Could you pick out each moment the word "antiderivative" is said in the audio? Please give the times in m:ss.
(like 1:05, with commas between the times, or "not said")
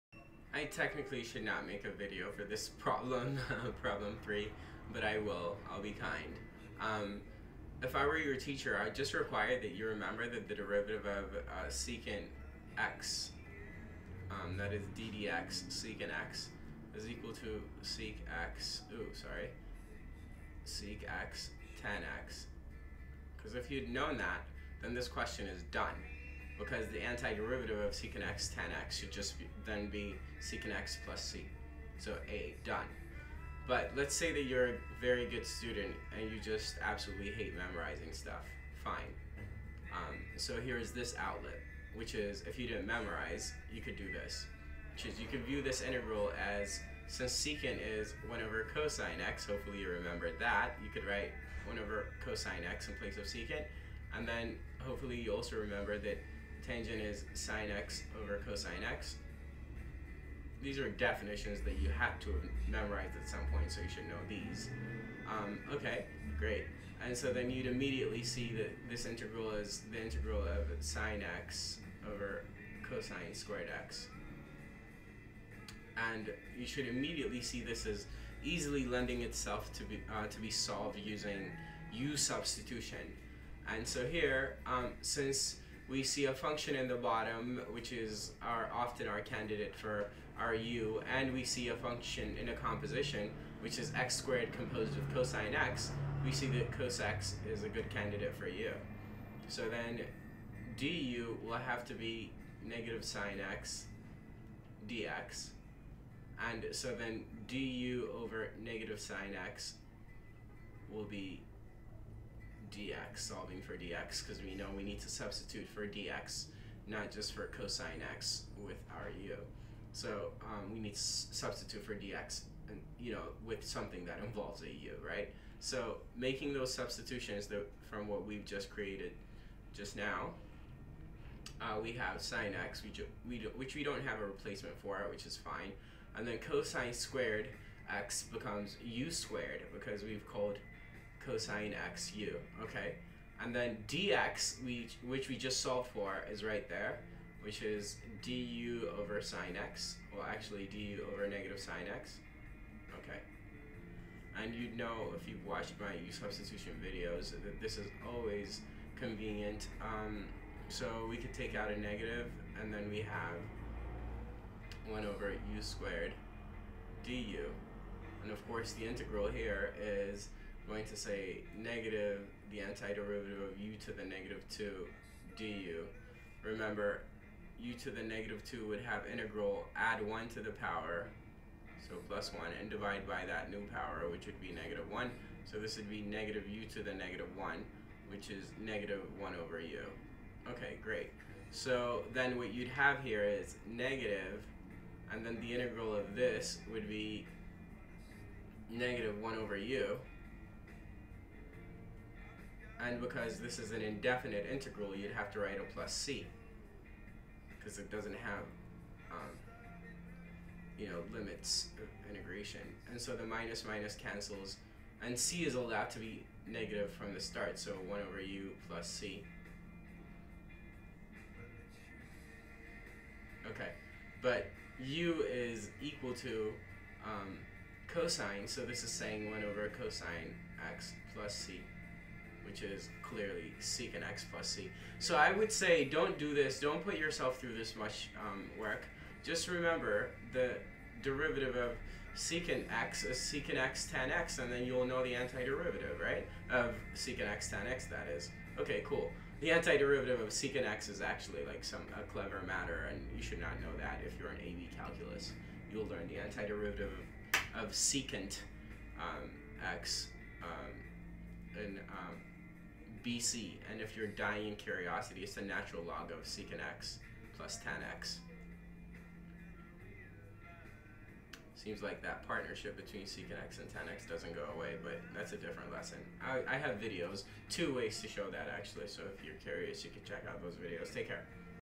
0:26, 2:52, 4:05, 4:09, 4:16.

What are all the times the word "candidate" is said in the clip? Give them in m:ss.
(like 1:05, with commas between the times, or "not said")
1:29, 1:37.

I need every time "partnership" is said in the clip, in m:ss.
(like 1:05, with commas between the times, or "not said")
4:32.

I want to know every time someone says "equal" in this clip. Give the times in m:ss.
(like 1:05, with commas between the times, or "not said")
0:17, 3:45.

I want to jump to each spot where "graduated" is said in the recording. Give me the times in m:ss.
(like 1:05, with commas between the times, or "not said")
not said.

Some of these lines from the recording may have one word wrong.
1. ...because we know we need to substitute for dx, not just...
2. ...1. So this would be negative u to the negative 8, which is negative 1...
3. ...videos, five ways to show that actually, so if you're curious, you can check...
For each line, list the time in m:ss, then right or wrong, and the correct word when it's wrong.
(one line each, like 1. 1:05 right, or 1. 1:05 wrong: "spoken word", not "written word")
1. 1:54 right
2. 3:04 wrong: "1", not "8"
3. 4:36 wrong: "two", not "five".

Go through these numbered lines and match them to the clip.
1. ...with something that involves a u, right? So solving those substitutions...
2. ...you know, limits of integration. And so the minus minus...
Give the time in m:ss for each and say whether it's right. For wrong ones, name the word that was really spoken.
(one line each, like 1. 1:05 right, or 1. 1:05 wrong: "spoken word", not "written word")
1. 2:03 wrong: "making", not "solving"
2. 3:30 right.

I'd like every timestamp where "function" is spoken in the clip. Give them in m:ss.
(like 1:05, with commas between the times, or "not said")
1:26, 1:31.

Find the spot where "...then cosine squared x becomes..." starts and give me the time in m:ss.
2:16.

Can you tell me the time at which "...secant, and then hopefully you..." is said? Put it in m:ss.
0:53.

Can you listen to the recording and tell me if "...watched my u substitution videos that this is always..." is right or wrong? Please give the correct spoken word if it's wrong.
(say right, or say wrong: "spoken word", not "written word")
right.